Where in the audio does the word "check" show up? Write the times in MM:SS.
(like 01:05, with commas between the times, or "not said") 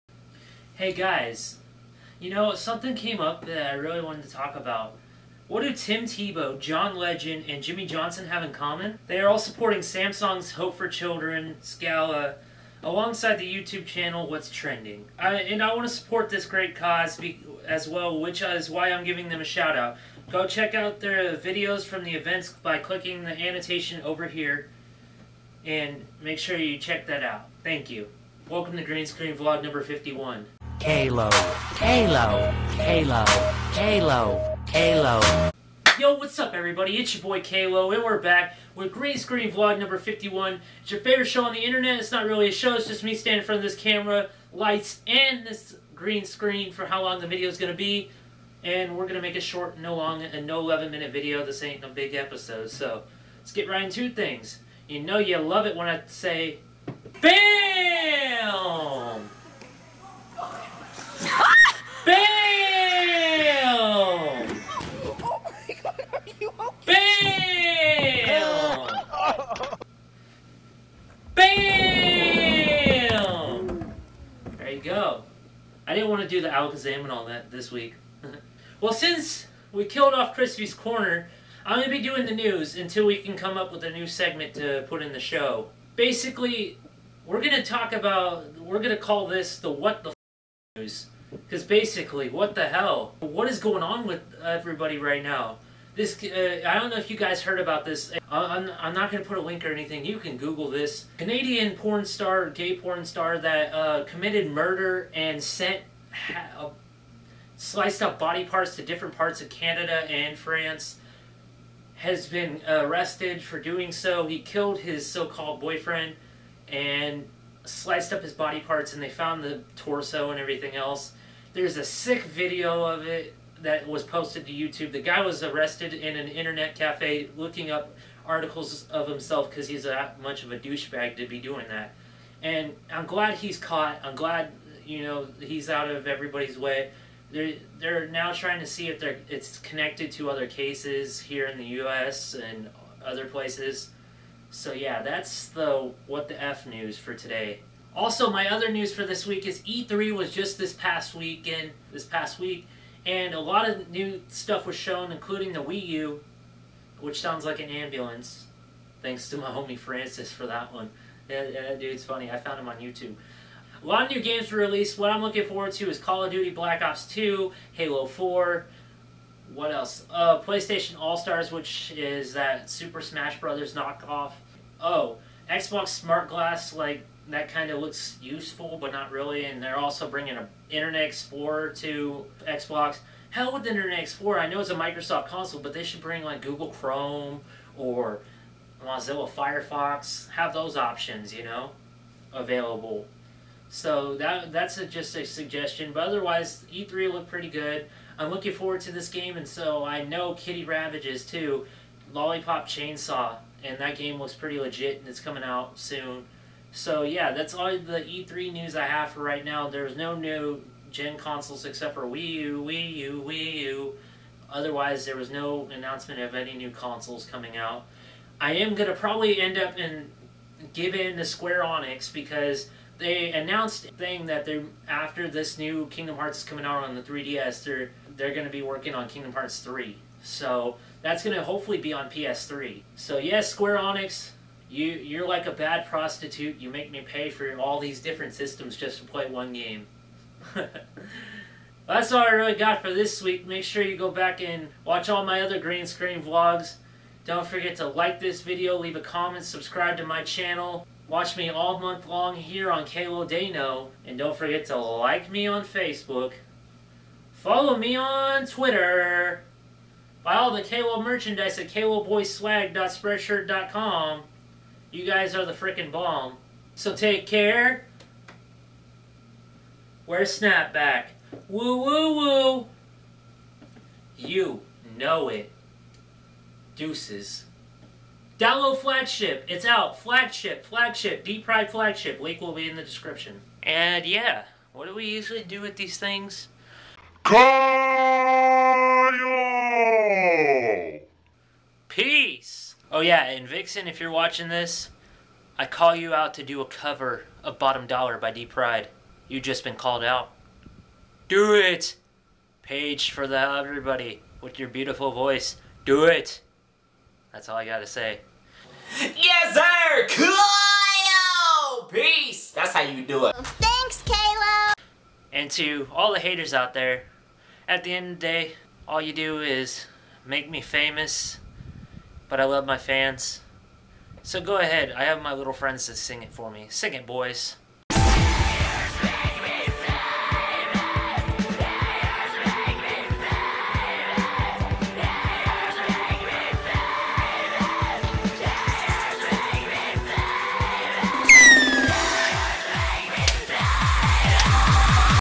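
00:20, 00:26.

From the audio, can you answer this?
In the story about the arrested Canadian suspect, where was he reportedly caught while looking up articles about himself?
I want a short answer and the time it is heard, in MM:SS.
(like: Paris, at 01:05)
Internet cafe, at 02:06.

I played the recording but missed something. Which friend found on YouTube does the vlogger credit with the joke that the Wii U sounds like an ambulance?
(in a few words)
Francis.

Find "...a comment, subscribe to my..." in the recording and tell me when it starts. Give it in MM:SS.
04:08.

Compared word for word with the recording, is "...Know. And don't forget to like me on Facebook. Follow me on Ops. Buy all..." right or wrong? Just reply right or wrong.
wrong.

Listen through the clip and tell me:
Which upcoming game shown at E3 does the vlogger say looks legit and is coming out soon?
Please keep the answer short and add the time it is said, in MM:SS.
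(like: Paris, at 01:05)
Lollipop Chainsaw, at 03:22.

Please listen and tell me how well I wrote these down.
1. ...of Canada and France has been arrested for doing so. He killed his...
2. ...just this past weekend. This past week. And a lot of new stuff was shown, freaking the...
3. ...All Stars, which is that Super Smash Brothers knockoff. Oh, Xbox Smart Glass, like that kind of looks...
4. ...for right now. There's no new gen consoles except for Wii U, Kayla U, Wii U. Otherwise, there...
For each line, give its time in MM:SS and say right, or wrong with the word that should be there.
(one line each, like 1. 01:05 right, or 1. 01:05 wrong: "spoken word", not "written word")
1. 01:49 right
2. 02:30 wrong: "including", not "freaking"
3. 02:50 right
4. 03:29 wrong: "Wii", not "Kayla".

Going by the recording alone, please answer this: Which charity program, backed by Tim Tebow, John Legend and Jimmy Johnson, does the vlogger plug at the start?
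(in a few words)
Samsung's Hope for Children.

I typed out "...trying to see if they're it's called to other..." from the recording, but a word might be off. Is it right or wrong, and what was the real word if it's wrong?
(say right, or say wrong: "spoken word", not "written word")
wrong: "connected", not "called".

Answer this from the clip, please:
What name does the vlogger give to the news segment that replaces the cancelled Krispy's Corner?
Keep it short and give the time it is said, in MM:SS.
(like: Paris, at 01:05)
What the News, at 01:29.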